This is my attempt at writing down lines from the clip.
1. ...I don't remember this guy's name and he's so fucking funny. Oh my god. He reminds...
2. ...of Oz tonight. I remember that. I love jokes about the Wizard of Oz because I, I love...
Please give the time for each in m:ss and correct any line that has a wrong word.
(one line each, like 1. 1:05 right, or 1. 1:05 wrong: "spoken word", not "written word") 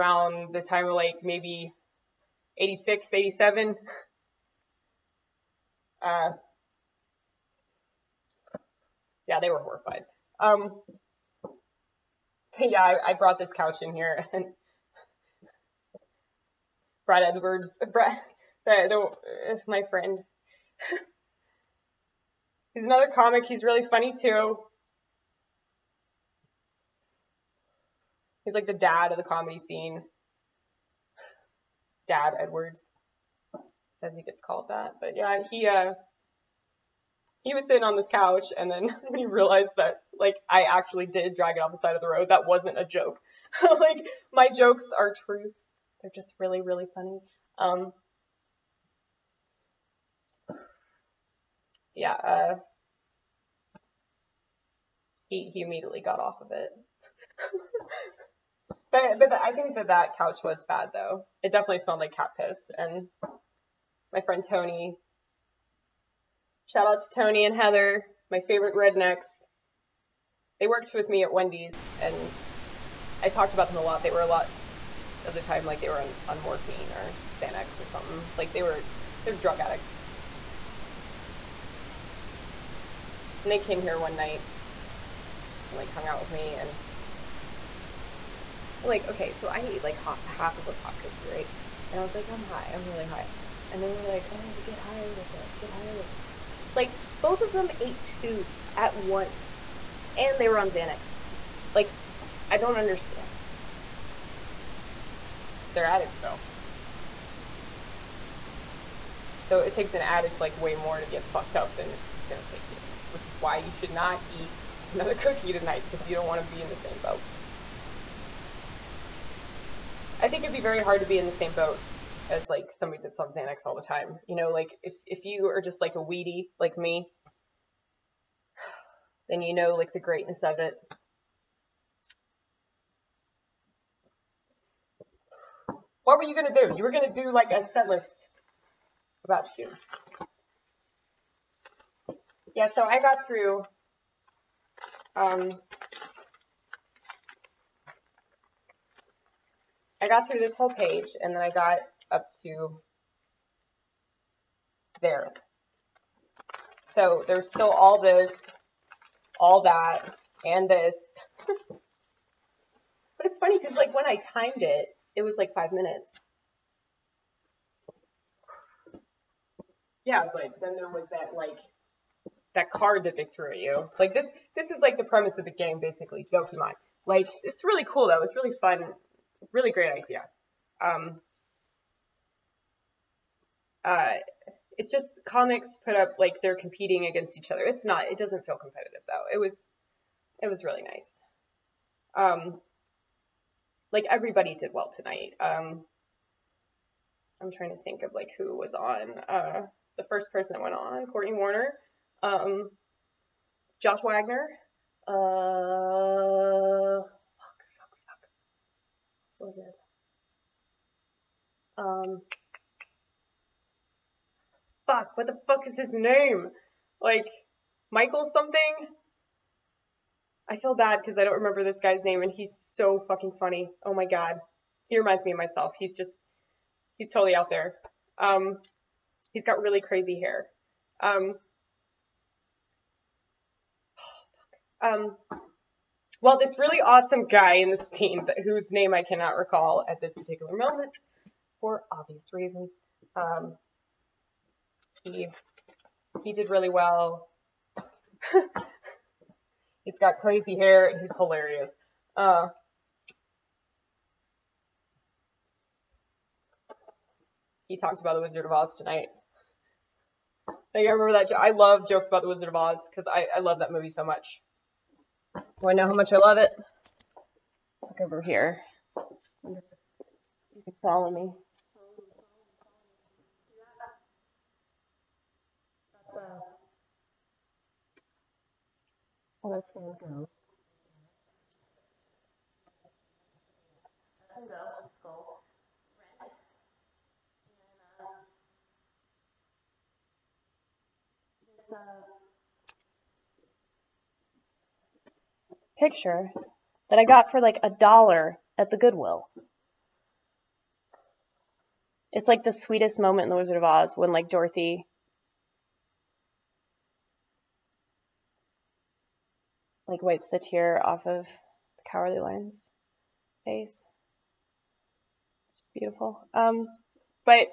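1. 3:41 right
2. 4:18 right.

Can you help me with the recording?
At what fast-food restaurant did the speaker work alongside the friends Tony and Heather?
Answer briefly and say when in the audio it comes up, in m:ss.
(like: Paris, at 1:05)
Wendy's, at 1:11.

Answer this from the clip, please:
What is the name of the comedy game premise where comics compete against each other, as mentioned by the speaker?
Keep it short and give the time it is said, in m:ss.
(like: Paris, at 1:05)
Jokemon, at 2:56.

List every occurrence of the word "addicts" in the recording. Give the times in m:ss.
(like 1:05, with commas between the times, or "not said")
1:19, 1:45, 1:50.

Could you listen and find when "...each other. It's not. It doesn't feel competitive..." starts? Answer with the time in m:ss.
3:07.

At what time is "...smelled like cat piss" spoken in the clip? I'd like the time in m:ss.
1:01.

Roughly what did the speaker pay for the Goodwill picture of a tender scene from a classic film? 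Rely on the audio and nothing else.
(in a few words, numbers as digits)
a dollar.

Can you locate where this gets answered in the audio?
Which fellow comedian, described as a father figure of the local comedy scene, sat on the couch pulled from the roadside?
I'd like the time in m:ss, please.
0:17.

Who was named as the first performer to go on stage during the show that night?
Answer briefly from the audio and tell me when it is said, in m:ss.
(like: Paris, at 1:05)
Courtney Warner, at 3:21.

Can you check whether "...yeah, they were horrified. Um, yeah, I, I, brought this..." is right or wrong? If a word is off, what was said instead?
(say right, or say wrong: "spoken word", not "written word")
right.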